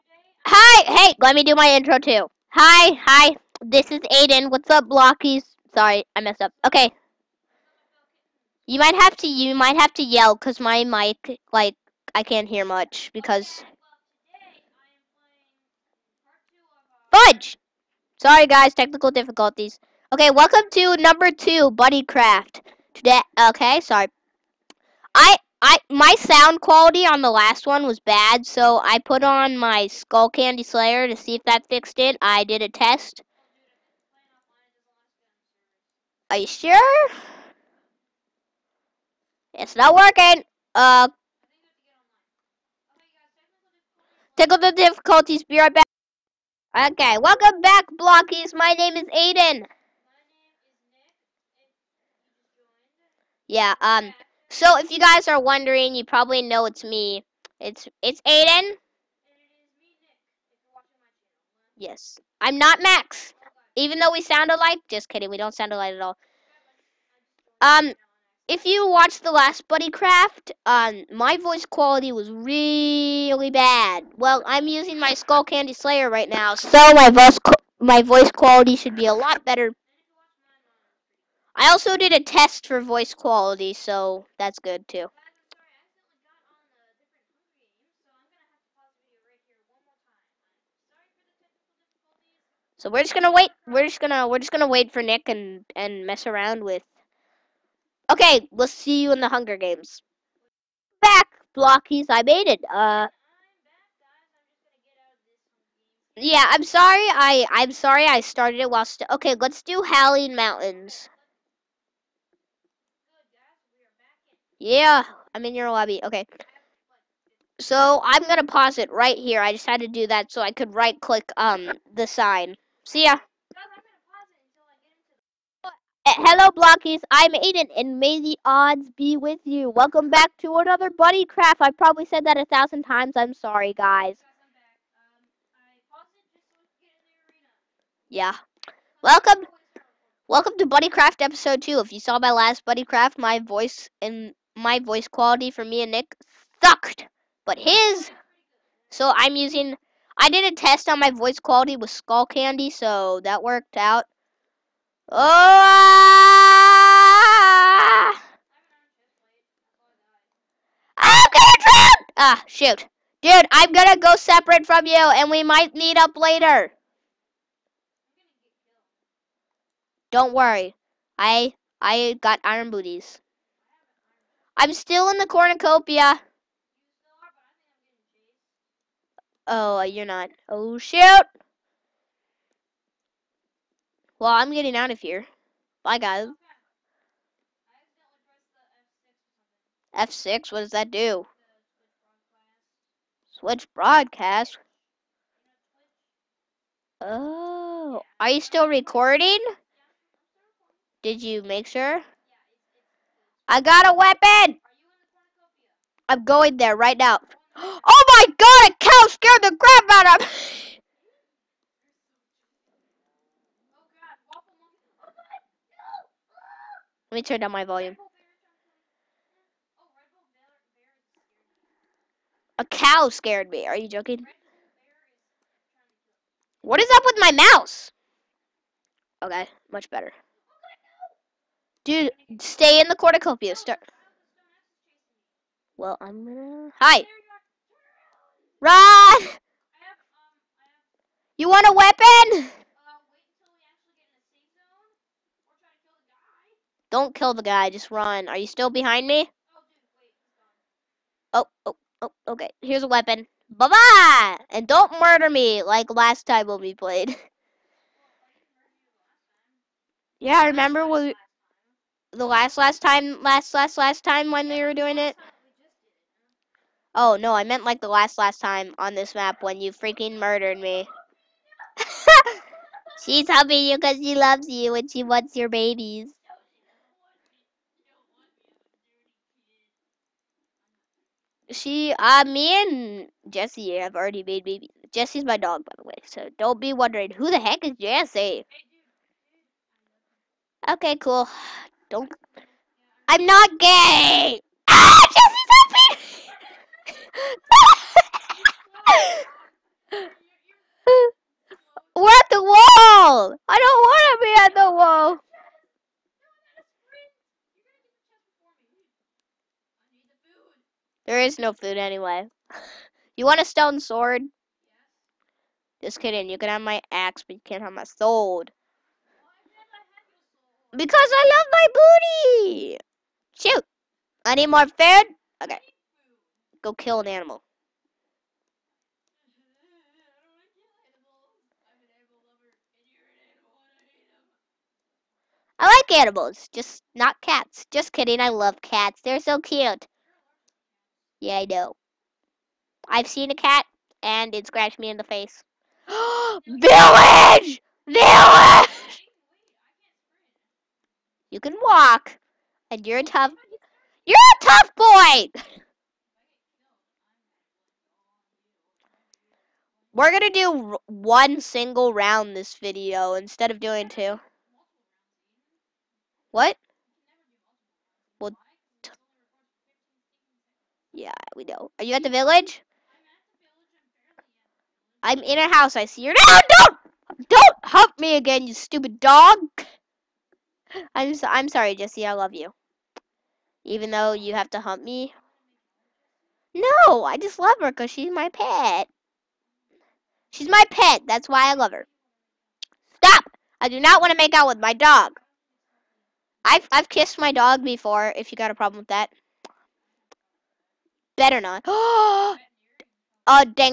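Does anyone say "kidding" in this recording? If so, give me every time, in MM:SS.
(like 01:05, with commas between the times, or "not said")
01:05, 05:15, 05:37.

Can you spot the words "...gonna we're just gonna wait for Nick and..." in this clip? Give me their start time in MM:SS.
01:34.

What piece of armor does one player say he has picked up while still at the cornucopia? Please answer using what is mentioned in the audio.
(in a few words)
iron booties.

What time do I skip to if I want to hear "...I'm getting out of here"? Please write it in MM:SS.
03:04.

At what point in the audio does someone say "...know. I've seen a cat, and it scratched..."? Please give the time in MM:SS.
05:41.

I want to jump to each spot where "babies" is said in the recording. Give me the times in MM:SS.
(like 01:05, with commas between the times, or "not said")
04:35, 04:44.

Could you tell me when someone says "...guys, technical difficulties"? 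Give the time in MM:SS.
00:18.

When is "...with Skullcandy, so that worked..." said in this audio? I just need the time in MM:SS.
02:31.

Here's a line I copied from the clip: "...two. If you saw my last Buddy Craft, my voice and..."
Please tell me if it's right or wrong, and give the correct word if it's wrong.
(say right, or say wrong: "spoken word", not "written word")
right.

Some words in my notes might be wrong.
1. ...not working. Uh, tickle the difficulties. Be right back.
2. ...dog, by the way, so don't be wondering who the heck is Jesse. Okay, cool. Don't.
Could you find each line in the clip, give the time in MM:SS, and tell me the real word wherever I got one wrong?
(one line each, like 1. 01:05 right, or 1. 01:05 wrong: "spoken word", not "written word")
1. 00:39 right
2. 04:45 right.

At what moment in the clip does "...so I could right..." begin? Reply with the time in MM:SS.
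02:00.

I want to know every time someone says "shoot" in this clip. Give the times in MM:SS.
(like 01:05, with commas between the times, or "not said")
02:42, 03:00, 05:23.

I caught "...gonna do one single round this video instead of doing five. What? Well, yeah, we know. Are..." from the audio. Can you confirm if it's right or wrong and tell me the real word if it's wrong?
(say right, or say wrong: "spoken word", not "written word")
wrong: "two", not "five".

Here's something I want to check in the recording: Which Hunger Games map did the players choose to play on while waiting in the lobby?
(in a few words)
Howling Mountains.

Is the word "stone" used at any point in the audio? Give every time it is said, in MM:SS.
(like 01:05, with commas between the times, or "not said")
05:13.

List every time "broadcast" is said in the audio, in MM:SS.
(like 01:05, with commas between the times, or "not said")
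03:13.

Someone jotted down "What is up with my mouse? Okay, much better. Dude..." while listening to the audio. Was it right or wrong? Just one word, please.
right.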